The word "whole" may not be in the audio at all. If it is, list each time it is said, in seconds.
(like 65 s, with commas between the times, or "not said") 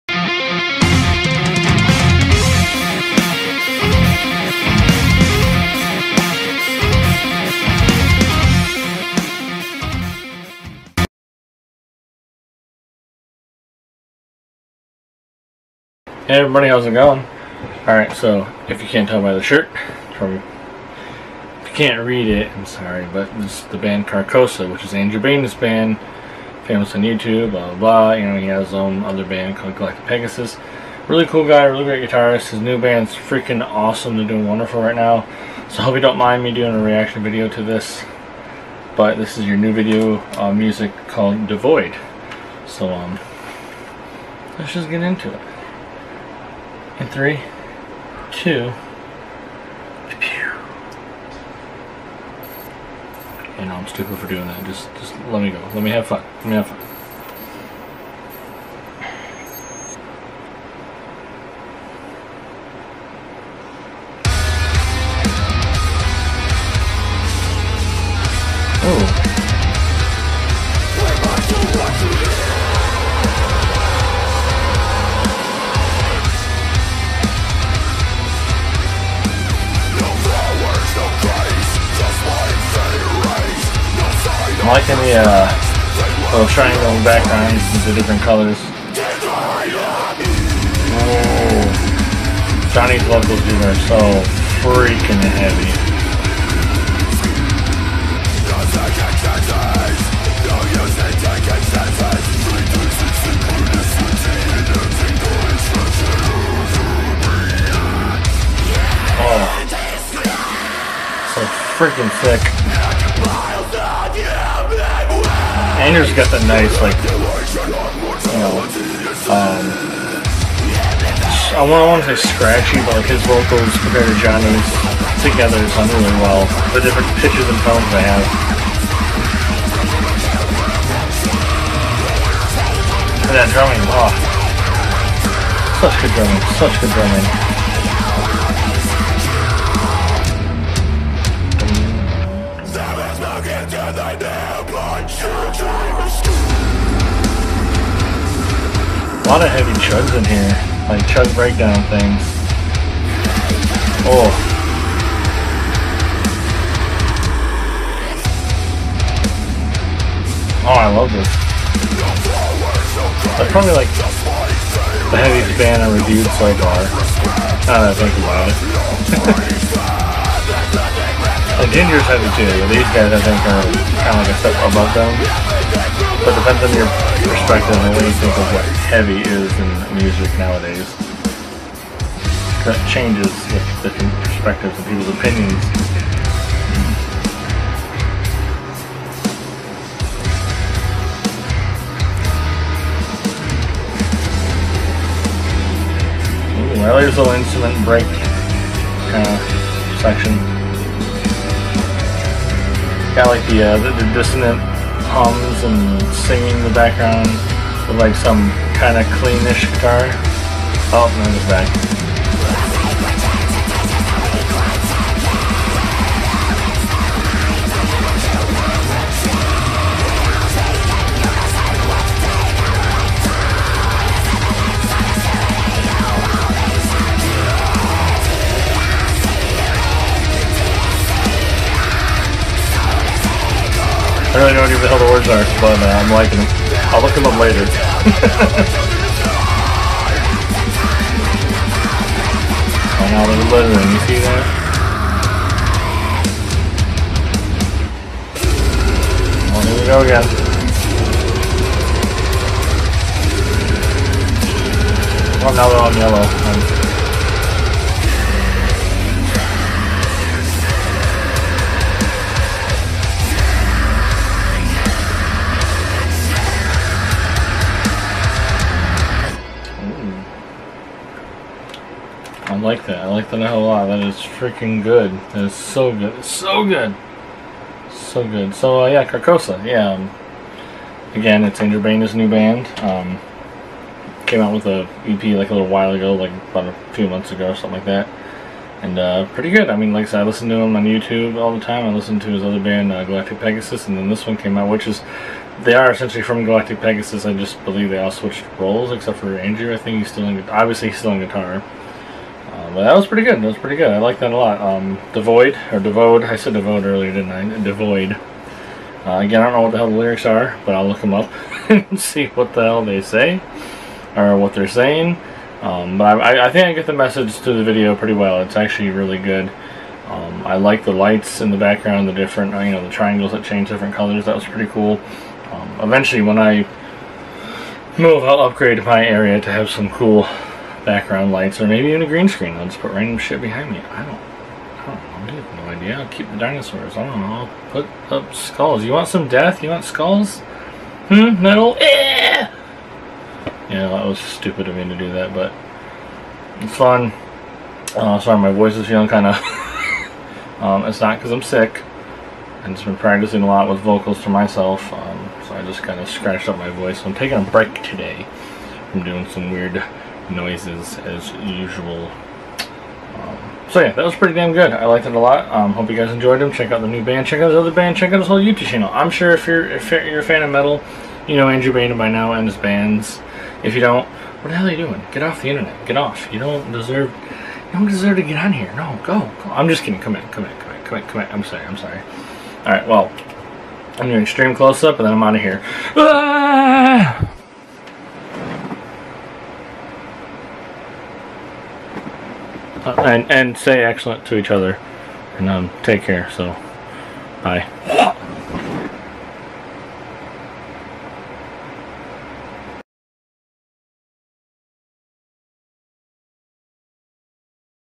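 368 s.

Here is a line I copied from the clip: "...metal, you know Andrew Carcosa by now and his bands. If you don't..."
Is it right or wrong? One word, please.
wrong.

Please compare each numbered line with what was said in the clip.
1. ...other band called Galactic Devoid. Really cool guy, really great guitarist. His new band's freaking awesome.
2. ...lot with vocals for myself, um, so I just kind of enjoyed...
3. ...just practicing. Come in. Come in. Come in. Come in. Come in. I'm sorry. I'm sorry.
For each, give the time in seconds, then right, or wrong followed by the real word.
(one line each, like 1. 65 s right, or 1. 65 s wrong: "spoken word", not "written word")
1. 29 s wrong: "Pegasus", not "Devoid"
2. 353 s wrong: "scratched", not "enjoyed"
3. 379 s wrong: "kidding", not "practicing".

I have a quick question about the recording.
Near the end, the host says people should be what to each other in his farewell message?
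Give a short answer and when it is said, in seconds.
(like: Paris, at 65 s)
excellent, at 393 s.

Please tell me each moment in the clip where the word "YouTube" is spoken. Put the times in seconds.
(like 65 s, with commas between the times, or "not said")
27 s, 290 s, 368 s.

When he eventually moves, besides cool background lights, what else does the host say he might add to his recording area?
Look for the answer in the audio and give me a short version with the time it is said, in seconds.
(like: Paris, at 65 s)
green screen, at 332 s.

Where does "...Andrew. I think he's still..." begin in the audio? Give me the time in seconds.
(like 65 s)
299 s.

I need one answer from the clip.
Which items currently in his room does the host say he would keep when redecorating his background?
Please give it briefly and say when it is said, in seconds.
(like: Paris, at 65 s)
dinosaurs, at 336 s.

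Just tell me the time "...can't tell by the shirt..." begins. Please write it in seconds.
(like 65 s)
18 s.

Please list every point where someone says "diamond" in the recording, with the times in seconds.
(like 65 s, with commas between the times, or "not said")
not said.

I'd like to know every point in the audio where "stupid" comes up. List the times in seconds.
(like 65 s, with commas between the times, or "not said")
53 s, 344 s.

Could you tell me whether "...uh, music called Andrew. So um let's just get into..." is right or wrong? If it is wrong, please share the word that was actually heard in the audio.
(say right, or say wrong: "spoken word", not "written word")
wrong: "Devoid", not "Andrew".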